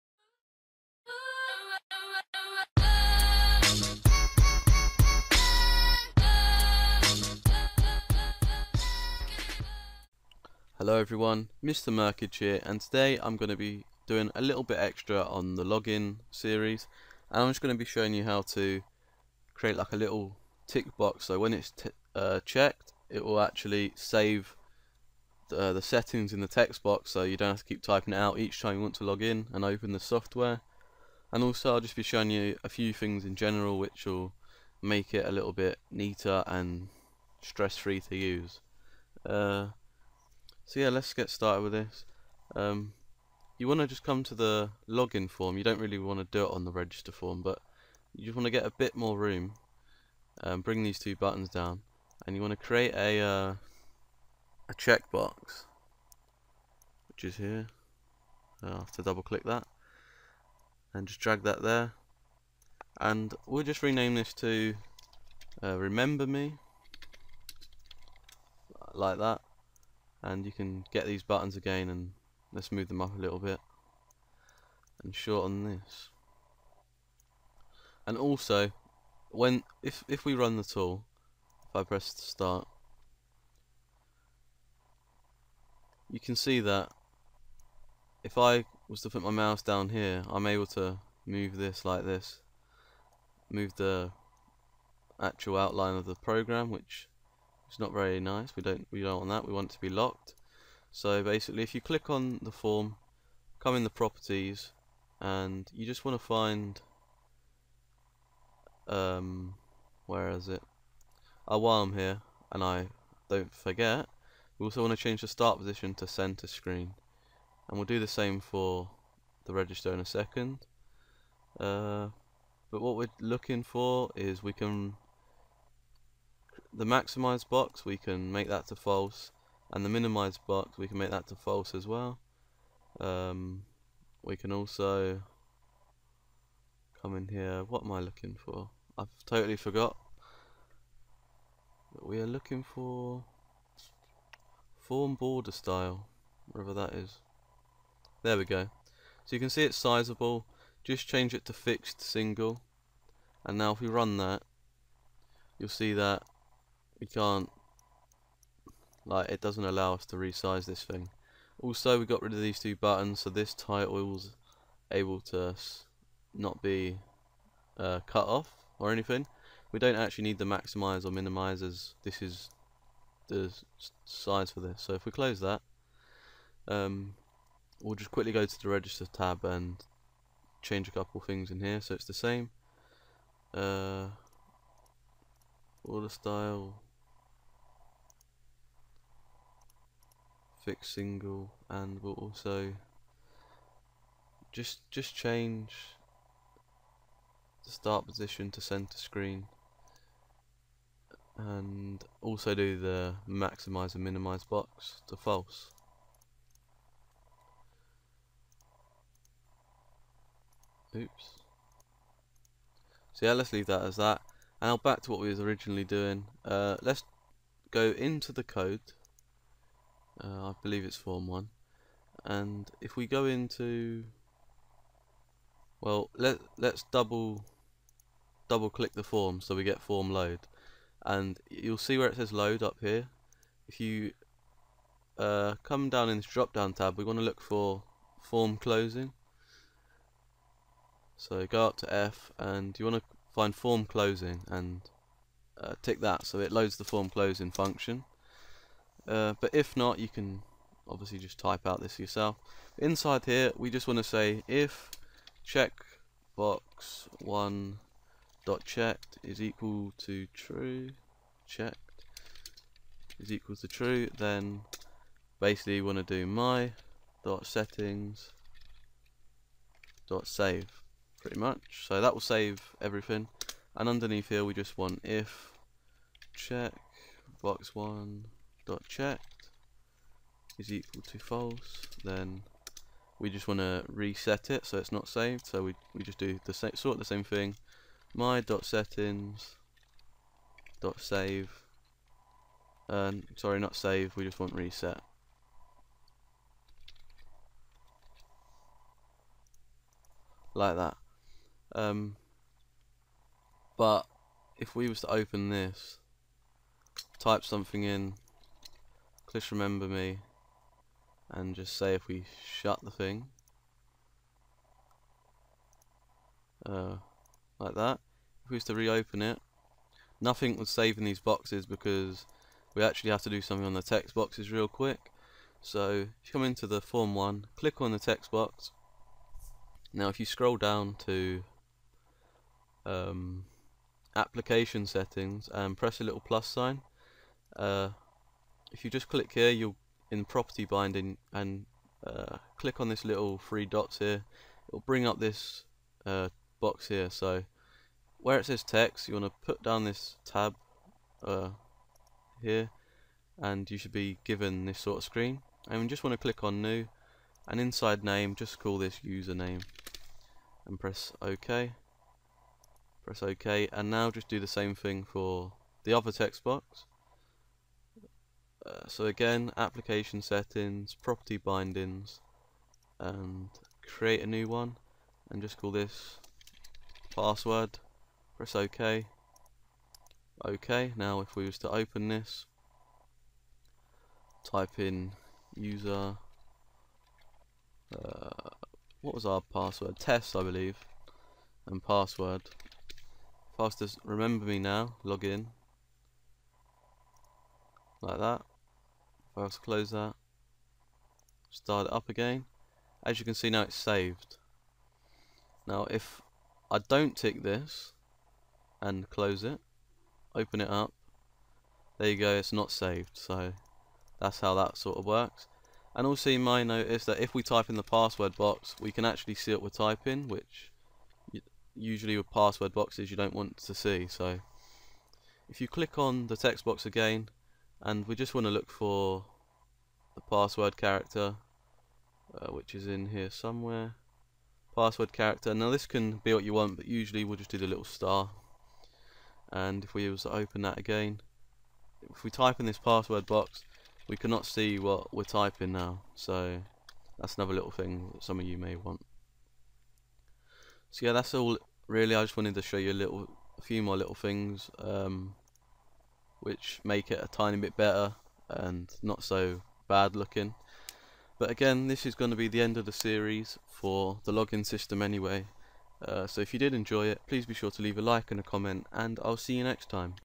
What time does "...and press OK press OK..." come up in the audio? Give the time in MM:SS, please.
06:00.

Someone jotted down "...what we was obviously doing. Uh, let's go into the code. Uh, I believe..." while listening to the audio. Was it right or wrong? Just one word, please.
wrong.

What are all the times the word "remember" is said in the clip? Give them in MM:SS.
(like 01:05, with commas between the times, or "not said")
01:05, 05:09, 06:34.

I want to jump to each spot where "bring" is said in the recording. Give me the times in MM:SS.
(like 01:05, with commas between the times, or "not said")
00:50, 05:44.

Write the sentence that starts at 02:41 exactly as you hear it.
Also we got rid of these two buttons so this title was able to not be uh, cut off or anything.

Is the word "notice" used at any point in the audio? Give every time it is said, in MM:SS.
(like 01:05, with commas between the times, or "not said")
06:56.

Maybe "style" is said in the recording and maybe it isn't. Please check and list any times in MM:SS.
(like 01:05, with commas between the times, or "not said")
02:25, 03:06.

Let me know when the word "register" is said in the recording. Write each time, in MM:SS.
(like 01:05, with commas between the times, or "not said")
00:46, 01:59, 02:58.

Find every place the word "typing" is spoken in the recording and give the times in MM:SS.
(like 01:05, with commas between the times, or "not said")
00:27, 06:59, 07:25.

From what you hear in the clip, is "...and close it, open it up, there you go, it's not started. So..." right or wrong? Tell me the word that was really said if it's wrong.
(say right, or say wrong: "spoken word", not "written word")
wrong: "saved", not "started".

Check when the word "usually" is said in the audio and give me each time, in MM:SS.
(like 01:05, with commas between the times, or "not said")
07:01, 07:16.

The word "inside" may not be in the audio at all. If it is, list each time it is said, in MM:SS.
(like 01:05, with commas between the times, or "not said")
04:12, 05:57.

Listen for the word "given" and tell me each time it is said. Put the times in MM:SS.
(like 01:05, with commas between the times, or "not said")
05:54.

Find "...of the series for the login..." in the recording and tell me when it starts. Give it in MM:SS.
07:42.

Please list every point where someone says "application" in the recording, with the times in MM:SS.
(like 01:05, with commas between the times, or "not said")
05:34, 06:09.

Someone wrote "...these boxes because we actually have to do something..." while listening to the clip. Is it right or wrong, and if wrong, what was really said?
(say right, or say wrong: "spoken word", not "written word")
right.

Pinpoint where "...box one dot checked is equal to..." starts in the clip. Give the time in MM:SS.
04:37.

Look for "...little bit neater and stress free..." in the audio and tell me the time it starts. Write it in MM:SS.
00:35.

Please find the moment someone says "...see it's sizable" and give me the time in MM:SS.
02:29.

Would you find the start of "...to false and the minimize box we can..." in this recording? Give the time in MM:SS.
02:08.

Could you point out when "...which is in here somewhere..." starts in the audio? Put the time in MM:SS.
07:12.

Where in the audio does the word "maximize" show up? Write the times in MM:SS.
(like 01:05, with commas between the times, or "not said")
02:06, 02:50, 03:23.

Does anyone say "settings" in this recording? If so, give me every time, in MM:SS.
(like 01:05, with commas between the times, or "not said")
00:25, 04:27, 04:48, 05:34, 06:10.